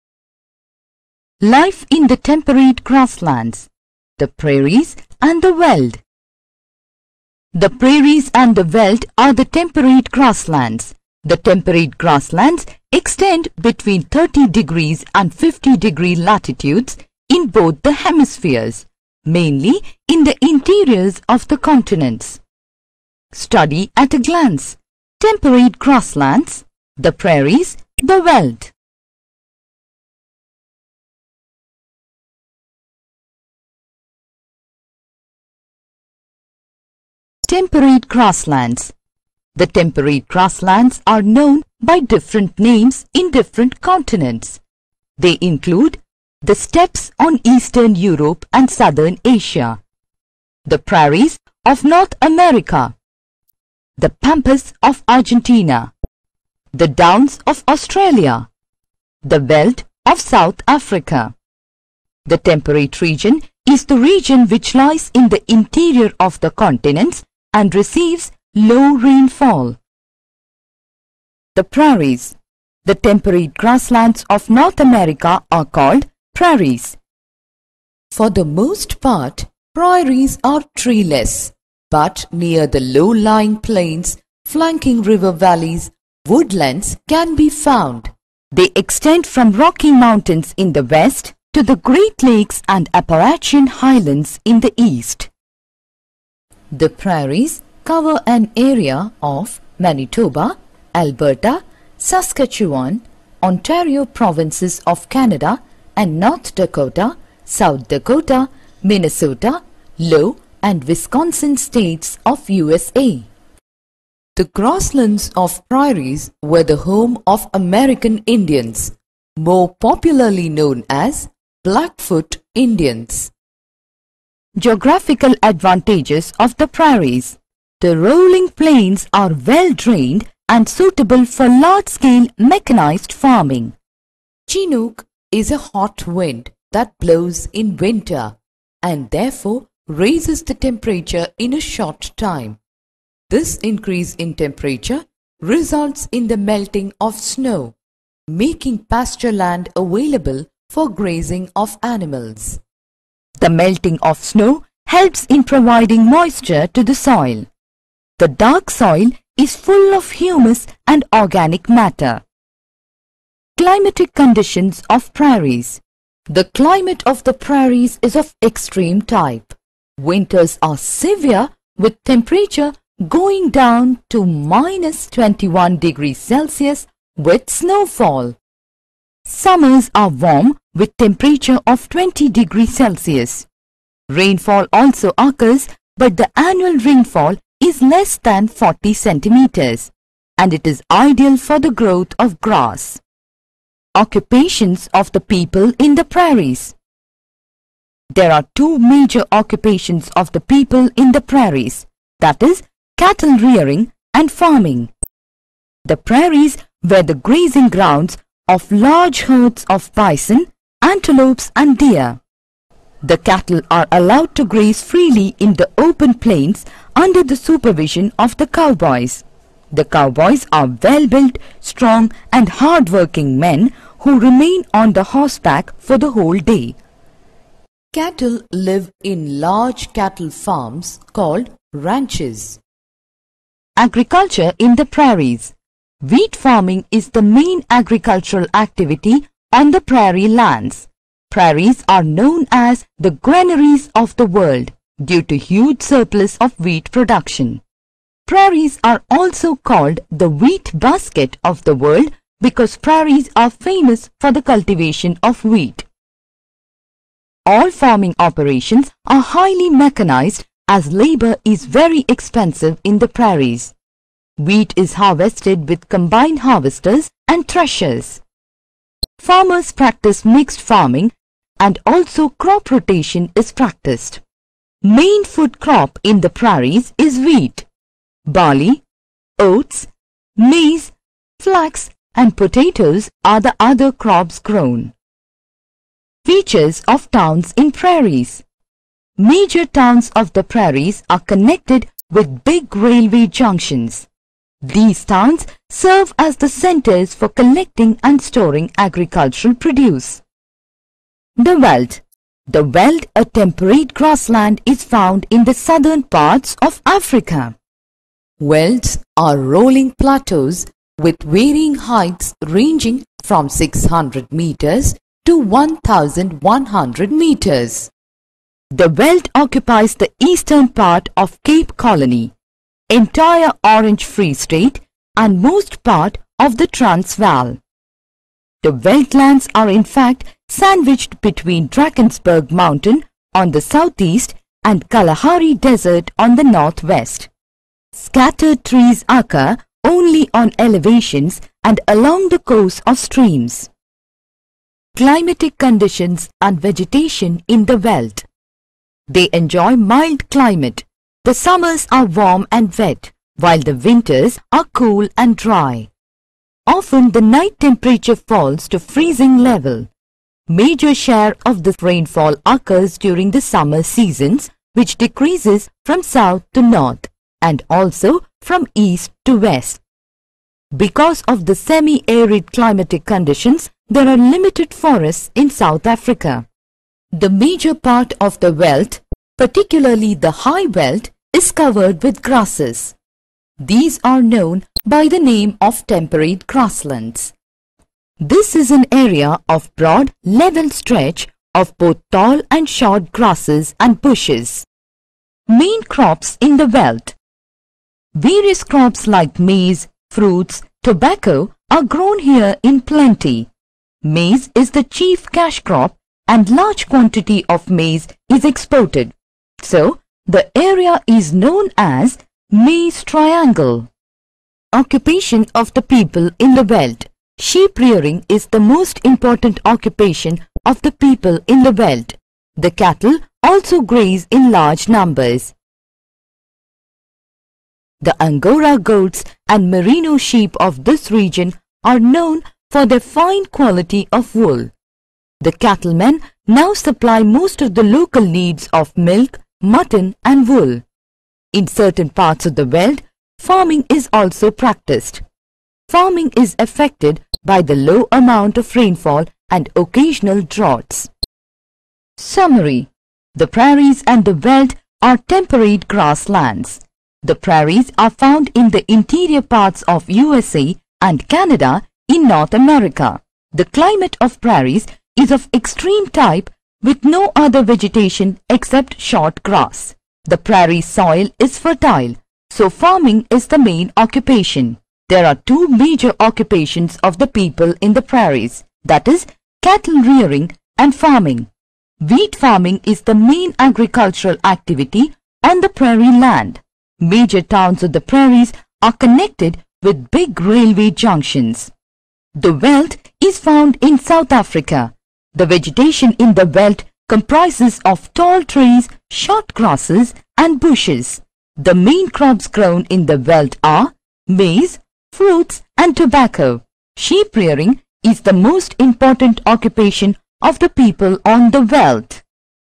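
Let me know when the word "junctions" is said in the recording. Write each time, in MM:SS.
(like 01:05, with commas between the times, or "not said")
04:53, 08:10.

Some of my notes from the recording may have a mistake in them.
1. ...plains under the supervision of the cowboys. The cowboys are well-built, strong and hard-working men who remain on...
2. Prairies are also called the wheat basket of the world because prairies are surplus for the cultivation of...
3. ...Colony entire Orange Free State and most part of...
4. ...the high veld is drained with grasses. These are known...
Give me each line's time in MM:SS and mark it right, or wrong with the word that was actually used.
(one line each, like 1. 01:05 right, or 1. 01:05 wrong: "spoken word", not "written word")
1. 03:36 right
2. 04:08 wrong: "famous", not "surplus"
3. 05:21 right
4. 06:20 wrong: "covered", not "drained".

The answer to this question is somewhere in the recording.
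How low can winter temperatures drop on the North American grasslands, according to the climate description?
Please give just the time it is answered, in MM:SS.
02:54.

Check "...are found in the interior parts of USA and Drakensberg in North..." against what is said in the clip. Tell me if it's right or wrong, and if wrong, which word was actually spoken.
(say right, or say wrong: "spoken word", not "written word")
wrong: "Canada", not "Drakensberg".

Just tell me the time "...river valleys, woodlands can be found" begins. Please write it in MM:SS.
01:25.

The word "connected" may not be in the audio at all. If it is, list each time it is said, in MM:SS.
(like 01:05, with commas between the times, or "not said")
04:51, 08:08.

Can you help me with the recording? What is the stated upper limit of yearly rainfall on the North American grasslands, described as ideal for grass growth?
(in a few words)
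40 centimeters.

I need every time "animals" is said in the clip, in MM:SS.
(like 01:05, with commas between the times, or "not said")
02:31.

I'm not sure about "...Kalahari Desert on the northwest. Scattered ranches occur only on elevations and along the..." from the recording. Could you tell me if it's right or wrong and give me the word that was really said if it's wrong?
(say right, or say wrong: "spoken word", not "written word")
wrong: "trees", not "ranches".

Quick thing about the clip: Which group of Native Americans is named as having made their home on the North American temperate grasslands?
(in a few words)
Blackfoot Indians.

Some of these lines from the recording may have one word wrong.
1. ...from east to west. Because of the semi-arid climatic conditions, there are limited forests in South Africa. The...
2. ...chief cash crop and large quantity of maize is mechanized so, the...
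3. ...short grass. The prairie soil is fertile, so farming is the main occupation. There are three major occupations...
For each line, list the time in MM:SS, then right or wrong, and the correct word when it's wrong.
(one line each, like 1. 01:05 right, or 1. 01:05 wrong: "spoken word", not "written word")
1. 06:08 right
2. 06:44 wrong: "exported", not "mechanized"
3. 07:48 wrong: "two", not "three".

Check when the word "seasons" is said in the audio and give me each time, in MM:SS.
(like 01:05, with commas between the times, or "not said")
06:03.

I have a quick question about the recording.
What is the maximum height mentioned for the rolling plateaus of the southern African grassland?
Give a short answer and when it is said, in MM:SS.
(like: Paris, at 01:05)
1100 meters, at 05:15.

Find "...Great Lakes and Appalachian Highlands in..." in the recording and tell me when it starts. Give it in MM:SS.
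01:31.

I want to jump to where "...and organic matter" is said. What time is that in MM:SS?
02:40.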